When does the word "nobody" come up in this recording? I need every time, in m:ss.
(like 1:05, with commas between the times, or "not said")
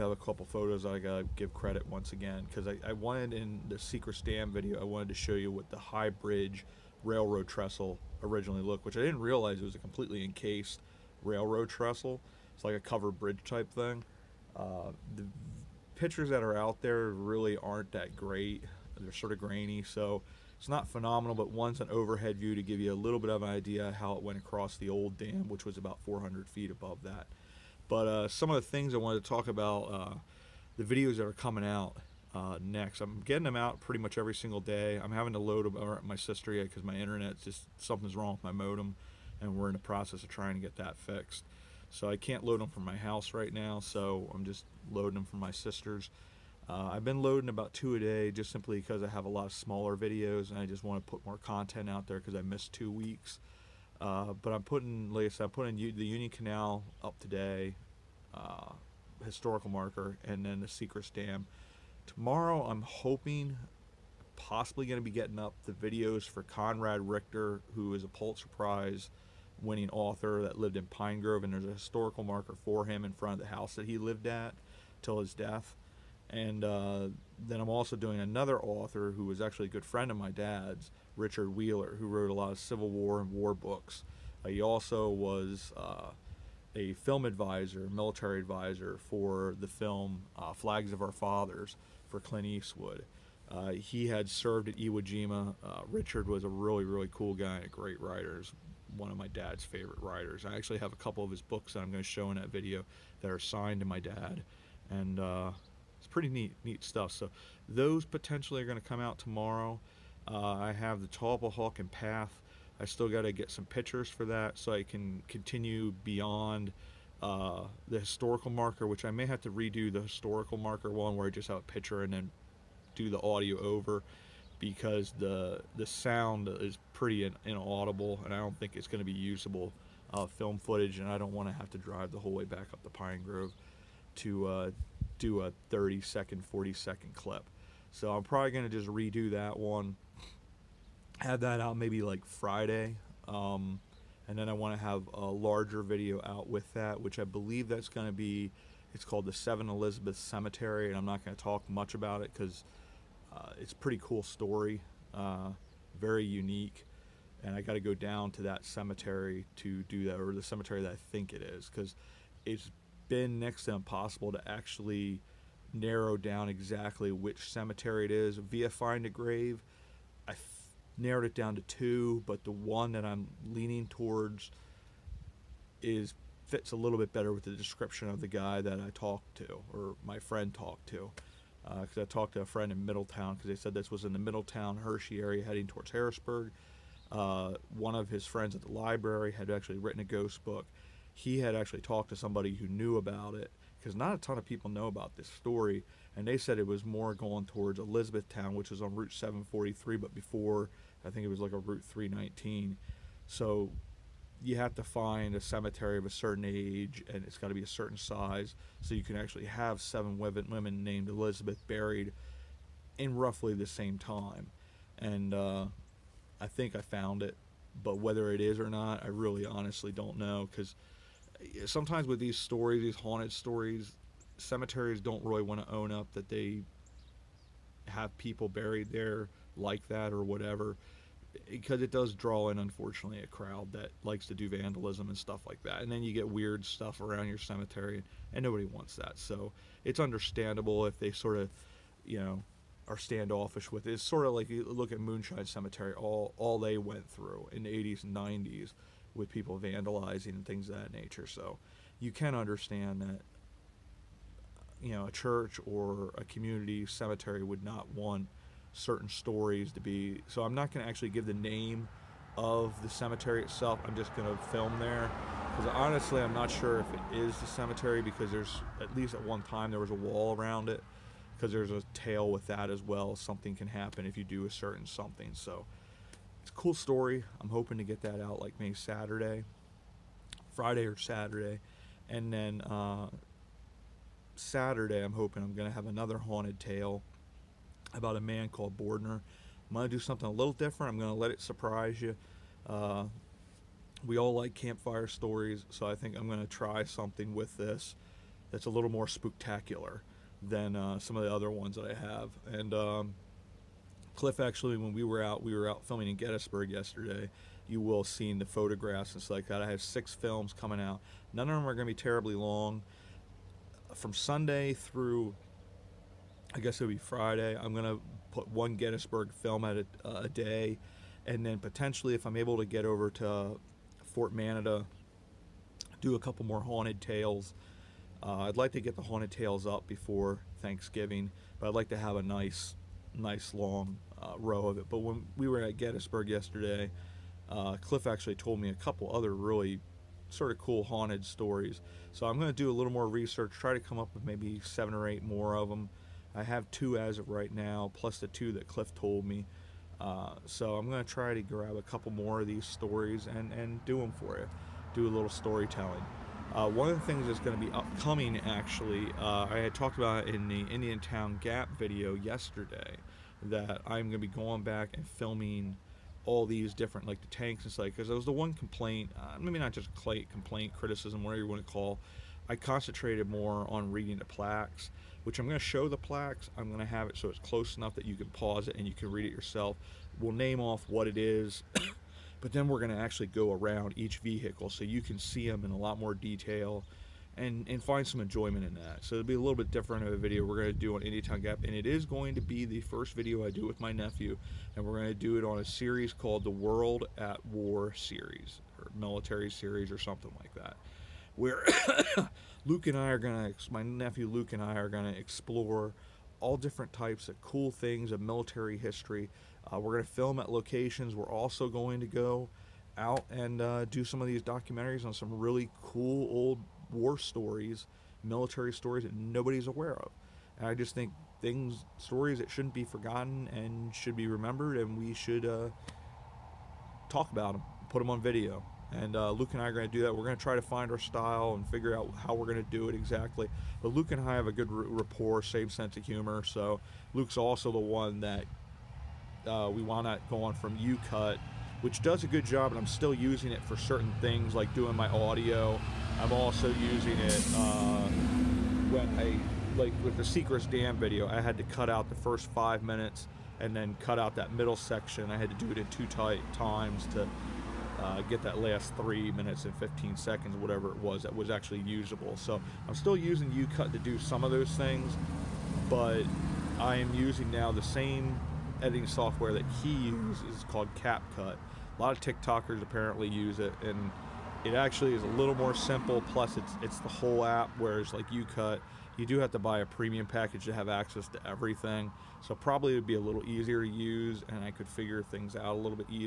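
3:58, 6:59.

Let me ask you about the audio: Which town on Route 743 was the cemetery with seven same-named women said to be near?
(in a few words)
Elizabethtown.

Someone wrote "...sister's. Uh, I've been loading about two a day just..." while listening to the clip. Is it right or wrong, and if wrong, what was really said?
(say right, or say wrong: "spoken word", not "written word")
right.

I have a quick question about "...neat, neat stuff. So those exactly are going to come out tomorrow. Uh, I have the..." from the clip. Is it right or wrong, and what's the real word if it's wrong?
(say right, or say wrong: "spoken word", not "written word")
wrong: "potentially", not "exactly".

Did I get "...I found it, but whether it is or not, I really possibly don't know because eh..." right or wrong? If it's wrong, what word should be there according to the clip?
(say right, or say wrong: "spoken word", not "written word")
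wrong: "honestly", not "possibly".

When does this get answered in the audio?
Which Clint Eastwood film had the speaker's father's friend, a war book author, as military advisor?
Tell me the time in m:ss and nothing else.
1:30.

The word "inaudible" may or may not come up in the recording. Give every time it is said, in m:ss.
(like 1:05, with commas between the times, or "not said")
2:07.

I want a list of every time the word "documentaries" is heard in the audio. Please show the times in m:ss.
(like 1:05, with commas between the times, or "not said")
6:54.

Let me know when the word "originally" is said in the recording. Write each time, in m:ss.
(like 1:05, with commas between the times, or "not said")
0:08.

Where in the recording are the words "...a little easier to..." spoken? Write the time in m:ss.
8:03.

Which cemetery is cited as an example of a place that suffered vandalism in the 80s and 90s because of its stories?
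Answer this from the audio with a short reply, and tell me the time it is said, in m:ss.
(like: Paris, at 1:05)
Moonshine Cemetery, at 4:05.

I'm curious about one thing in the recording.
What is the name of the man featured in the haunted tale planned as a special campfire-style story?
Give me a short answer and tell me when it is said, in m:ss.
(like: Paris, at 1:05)
Bordner, at 4:48.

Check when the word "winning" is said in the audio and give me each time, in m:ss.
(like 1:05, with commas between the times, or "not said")
1:09.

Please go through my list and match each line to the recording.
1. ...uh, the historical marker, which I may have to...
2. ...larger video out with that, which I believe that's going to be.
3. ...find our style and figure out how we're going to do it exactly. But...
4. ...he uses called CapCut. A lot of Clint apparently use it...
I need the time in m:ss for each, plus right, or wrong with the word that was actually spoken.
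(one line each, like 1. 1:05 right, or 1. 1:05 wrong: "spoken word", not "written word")
1. 1:57 right
2. 2:25 right
3. 7:10 right
4. 7:49 wrong: "TikTokers", not "Clint".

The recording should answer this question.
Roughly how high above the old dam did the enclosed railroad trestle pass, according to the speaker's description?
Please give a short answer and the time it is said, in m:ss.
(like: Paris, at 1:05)
400 feet, at 0:26.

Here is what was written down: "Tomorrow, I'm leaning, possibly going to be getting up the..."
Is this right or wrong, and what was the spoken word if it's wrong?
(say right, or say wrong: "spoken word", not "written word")
wrong: "hoping", not "leaning".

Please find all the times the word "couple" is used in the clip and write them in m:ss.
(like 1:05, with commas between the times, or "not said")
0:00, 1:40, 5:26, 5:38, 5:51.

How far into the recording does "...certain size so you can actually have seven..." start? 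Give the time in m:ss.
3:27.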